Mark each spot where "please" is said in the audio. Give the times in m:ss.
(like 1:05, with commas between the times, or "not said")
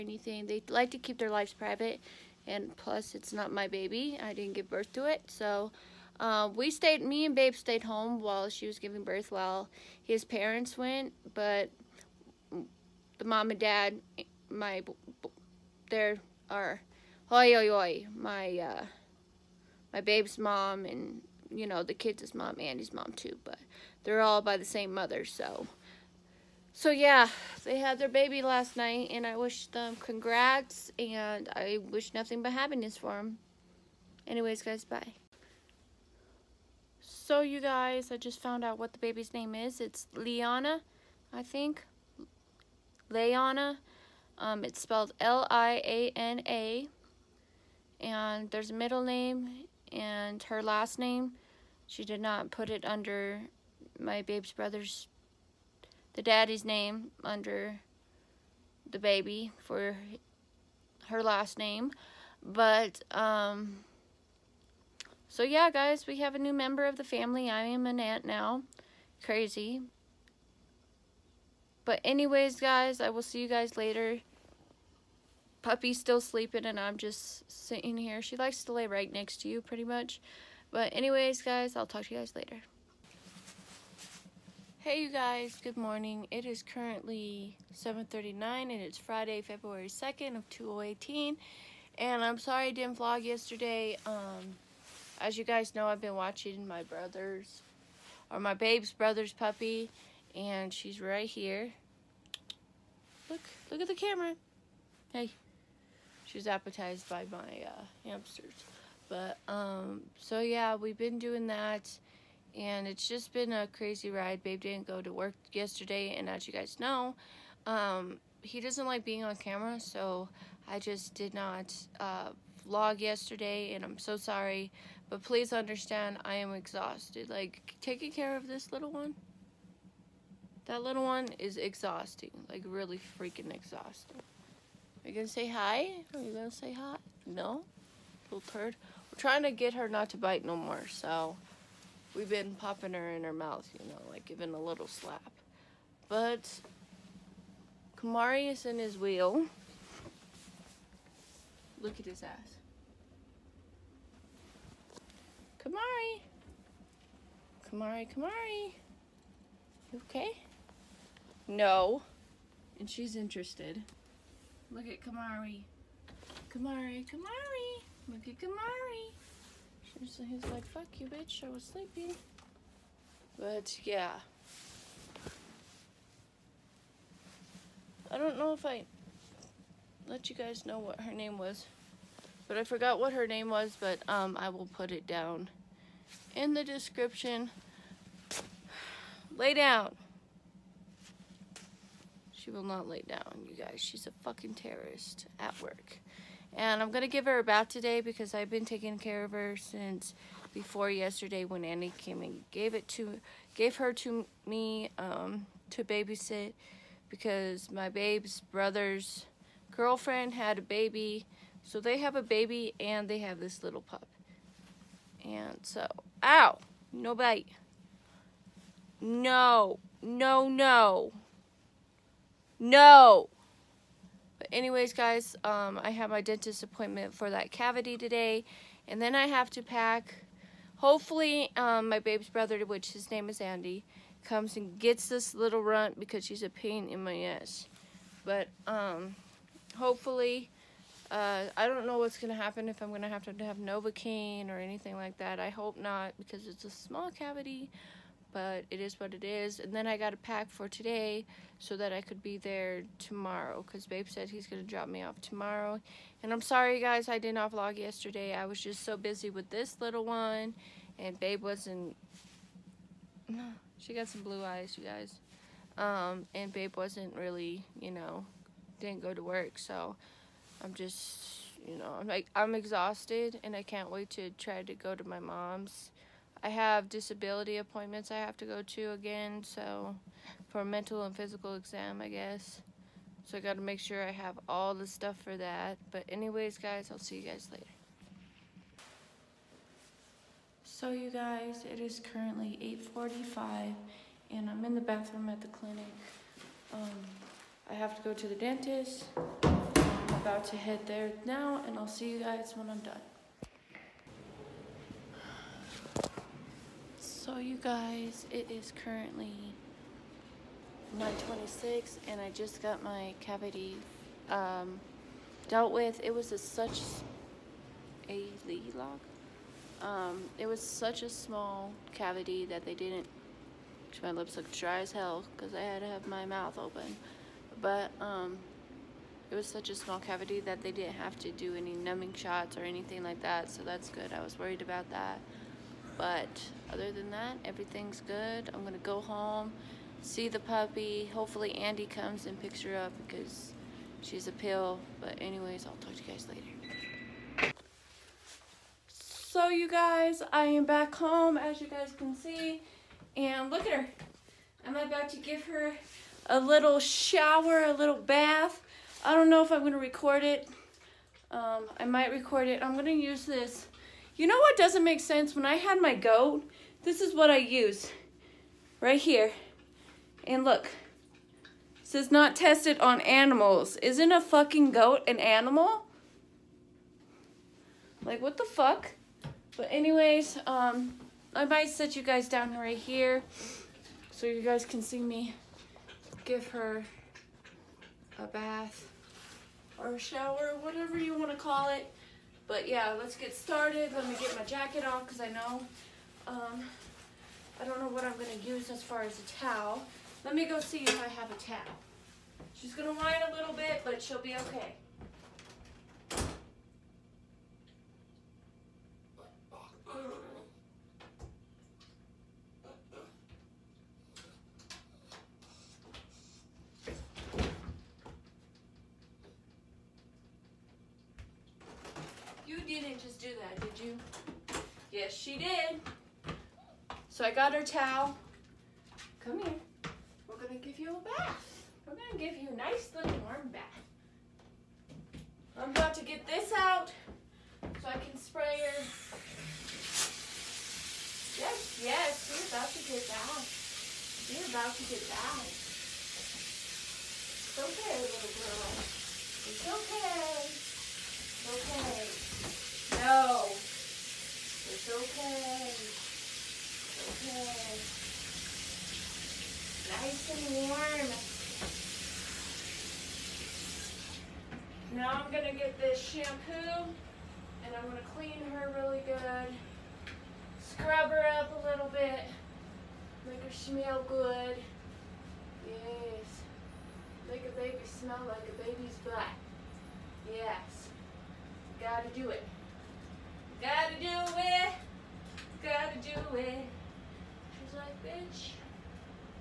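2:05.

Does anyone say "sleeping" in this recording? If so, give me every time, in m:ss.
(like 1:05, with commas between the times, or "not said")
1:16, 2:51.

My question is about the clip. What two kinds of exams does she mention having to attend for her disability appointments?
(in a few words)
Mental and physical.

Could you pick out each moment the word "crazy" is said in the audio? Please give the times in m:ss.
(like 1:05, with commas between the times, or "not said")
1:09, 1:53.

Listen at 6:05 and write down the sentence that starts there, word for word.
When I had my goat, this is what I use right here.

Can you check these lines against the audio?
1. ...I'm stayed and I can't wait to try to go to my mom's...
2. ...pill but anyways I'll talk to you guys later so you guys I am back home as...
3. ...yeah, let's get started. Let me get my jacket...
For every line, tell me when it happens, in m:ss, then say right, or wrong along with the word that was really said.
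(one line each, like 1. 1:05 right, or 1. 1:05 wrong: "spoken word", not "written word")
1. 4:32 wrong: "exhausted", not "stayed"
2. 5:44 right
3. 6:32 right.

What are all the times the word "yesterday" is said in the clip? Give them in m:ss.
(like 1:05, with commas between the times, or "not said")
1:33, 1:55, 2:02, 3:20, 4:17.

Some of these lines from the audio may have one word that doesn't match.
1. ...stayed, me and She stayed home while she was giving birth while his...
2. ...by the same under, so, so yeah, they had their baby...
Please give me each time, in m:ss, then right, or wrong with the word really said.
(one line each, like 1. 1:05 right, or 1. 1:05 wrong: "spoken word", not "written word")
1. 0:06 wrong: "Babe", not "She"
2. 0:24 wrong: "mother", not "under".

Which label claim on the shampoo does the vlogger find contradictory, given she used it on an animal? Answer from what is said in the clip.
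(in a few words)
Not tested on animals.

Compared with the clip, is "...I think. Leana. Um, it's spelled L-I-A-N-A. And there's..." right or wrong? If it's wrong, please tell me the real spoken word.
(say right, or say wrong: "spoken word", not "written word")
right.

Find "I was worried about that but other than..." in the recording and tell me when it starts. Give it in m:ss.
5:34.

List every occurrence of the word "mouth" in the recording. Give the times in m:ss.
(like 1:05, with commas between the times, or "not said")
2:23, 5:26.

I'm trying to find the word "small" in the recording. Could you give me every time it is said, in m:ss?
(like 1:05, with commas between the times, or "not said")
4:06, 5:21, 5:29.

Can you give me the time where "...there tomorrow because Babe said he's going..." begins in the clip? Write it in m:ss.
4:12.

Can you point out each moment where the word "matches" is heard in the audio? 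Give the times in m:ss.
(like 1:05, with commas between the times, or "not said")
not said.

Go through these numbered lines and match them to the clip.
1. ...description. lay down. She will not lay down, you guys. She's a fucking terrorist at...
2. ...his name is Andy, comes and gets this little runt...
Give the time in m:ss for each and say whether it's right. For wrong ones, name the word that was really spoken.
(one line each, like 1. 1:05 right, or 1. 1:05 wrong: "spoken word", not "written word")
1. 3:06 right
2. 3:52 right.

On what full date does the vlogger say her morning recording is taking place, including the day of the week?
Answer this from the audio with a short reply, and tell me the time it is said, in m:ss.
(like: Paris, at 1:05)
Friday, February 2nd, 2018, at 1:28.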